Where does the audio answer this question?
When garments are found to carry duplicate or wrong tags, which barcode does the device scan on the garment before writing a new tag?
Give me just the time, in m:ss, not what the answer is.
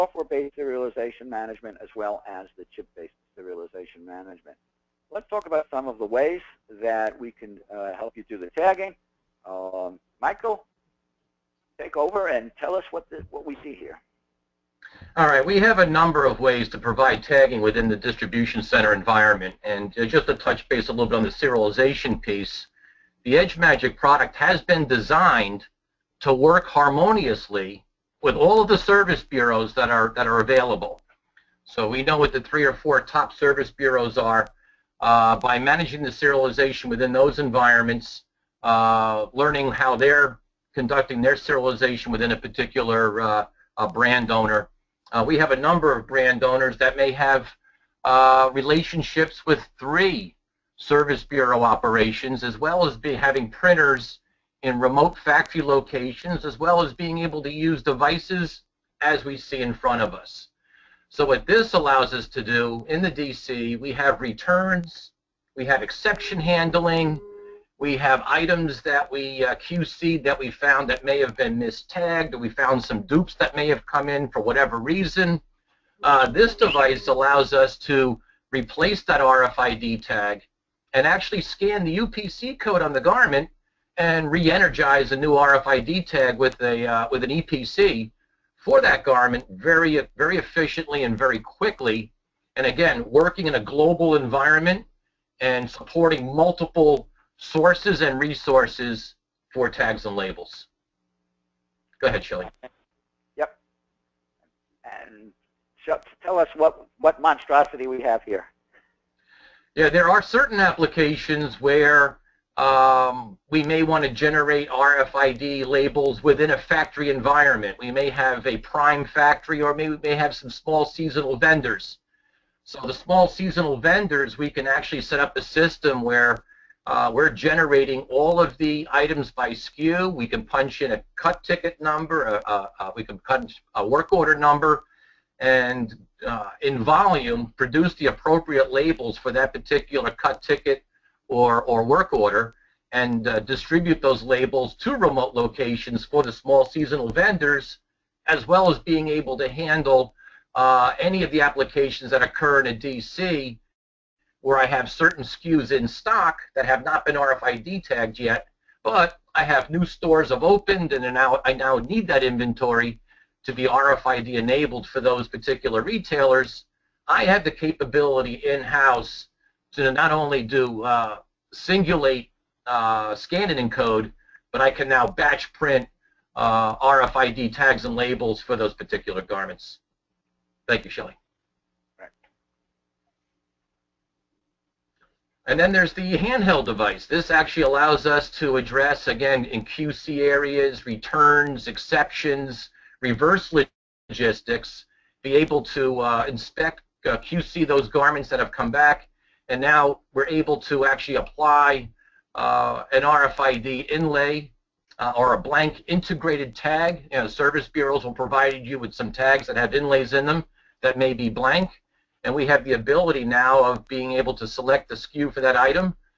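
1:21.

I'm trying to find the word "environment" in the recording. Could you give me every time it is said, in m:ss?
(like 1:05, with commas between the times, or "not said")
0:18, 0:37, 1:34, 1:57.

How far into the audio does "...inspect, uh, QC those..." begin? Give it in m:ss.
3:16.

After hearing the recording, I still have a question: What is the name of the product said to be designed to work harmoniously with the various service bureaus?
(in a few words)
EdgeMagic.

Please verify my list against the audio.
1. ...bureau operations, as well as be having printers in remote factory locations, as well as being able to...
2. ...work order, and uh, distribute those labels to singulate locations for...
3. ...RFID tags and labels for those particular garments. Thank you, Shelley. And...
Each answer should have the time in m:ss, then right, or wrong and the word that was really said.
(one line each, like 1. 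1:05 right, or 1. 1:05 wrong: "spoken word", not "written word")
1. 0:51 right
2. 2:21 wrong: "remote", not "singulate"
3. 2:56 right.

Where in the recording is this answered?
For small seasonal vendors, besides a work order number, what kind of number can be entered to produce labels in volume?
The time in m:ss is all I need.
2:11.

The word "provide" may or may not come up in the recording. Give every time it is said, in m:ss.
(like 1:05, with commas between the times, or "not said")
0:16, 3:28.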